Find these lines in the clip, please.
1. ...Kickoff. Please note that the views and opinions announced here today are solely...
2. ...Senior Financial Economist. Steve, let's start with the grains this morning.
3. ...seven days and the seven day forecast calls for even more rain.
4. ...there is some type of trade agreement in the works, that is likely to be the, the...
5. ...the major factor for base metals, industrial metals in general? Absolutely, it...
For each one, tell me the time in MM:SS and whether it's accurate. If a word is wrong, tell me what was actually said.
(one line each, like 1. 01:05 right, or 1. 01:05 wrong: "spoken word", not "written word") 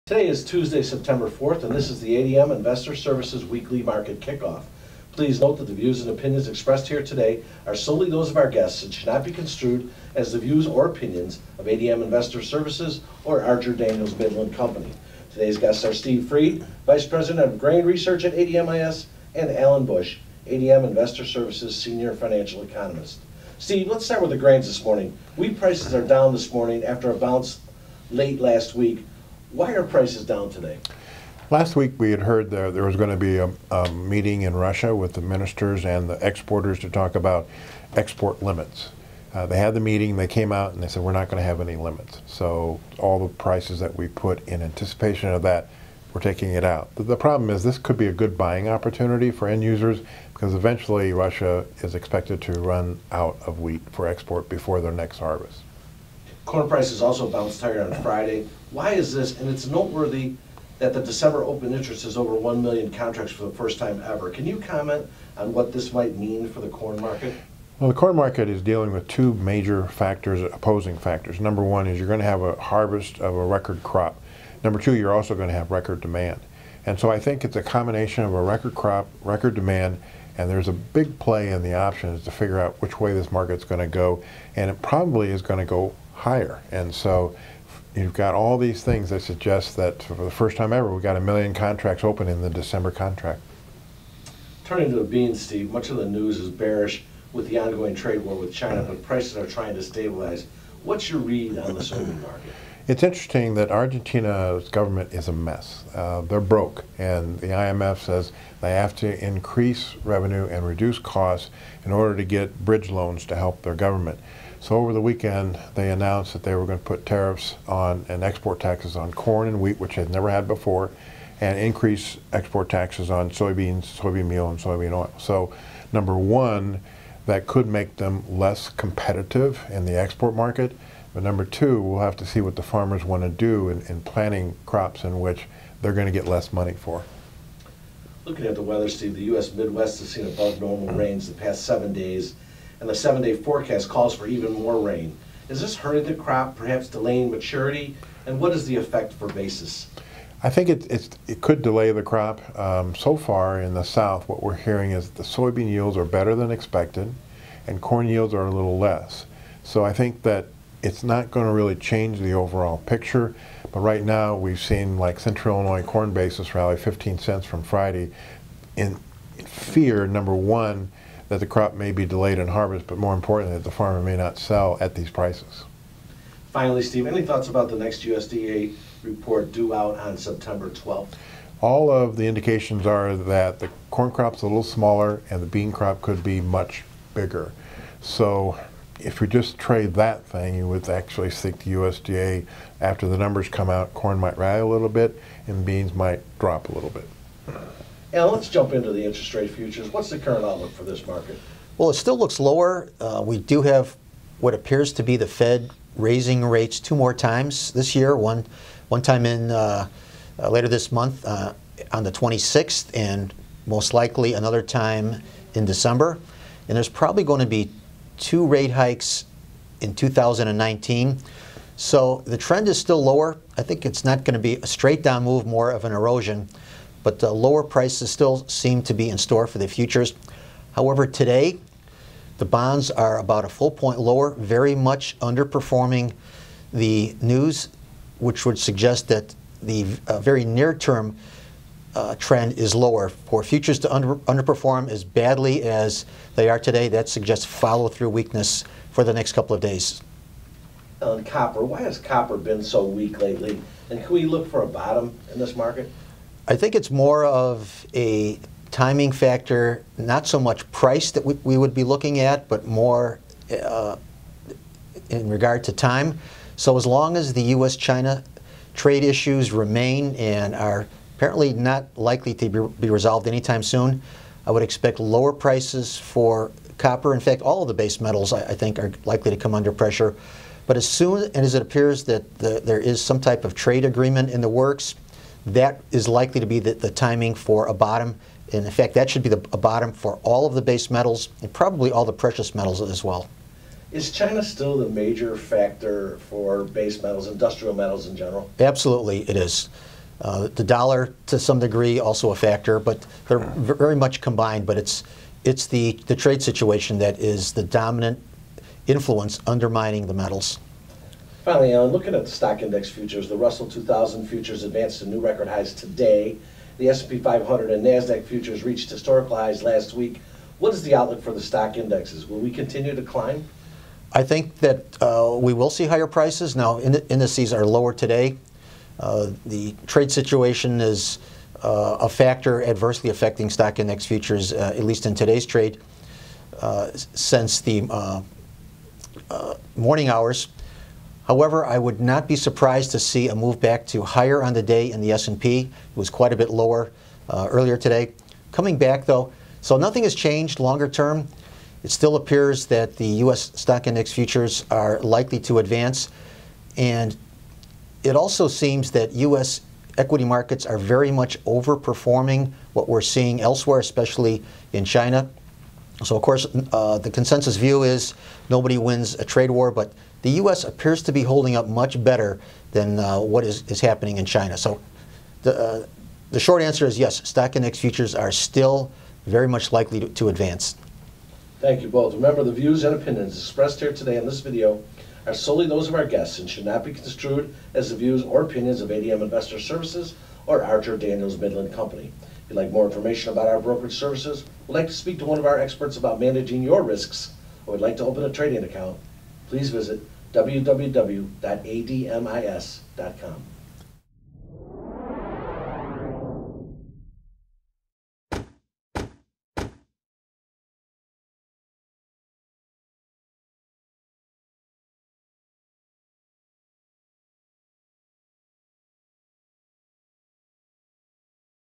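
1. 00:04 wrong: "expressed", not "announced"
2. 00:21 right
3. 02:21 right
4. 04:42 right
5. 04:54 right.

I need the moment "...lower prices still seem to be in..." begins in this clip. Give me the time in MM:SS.
03:47.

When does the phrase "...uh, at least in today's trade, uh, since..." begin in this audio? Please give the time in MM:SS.
05:34.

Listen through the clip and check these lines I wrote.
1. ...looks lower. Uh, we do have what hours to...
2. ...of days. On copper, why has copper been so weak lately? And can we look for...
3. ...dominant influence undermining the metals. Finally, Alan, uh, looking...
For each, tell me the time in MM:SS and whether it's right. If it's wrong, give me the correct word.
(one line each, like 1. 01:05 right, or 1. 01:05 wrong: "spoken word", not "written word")
1. 03:22 wrong: "appears", not "hours"
2. 04:09 right
3. 05:07 right.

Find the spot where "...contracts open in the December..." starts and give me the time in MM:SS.
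01:31.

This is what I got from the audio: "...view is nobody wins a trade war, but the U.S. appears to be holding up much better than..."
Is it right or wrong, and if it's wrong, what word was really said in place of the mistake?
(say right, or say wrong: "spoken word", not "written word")
right.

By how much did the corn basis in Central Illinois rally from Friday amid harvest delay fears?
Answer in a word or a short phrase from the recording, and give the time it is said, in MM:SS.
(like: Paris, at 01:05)
15 cents, at 02:46.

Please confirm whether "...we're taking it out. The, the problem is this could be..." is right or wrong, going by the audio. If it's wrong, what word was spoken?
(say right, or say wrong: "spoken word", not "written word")
right.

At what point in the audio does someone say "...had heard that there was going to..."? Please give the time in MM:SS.
00:32.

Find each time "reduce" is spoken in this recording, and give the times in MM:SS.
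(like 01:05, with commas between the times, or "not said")
01:50.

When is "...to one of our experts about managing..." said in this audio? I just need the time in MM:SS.
06:35.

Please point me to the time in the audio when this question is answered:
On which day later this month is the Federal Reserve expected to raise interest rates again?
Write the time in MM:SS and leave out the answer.
03:32.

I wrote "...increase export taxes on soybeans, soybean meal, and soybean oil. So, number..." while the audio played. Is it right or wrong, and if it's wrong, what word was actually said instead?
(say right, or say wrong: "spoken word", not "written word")
right.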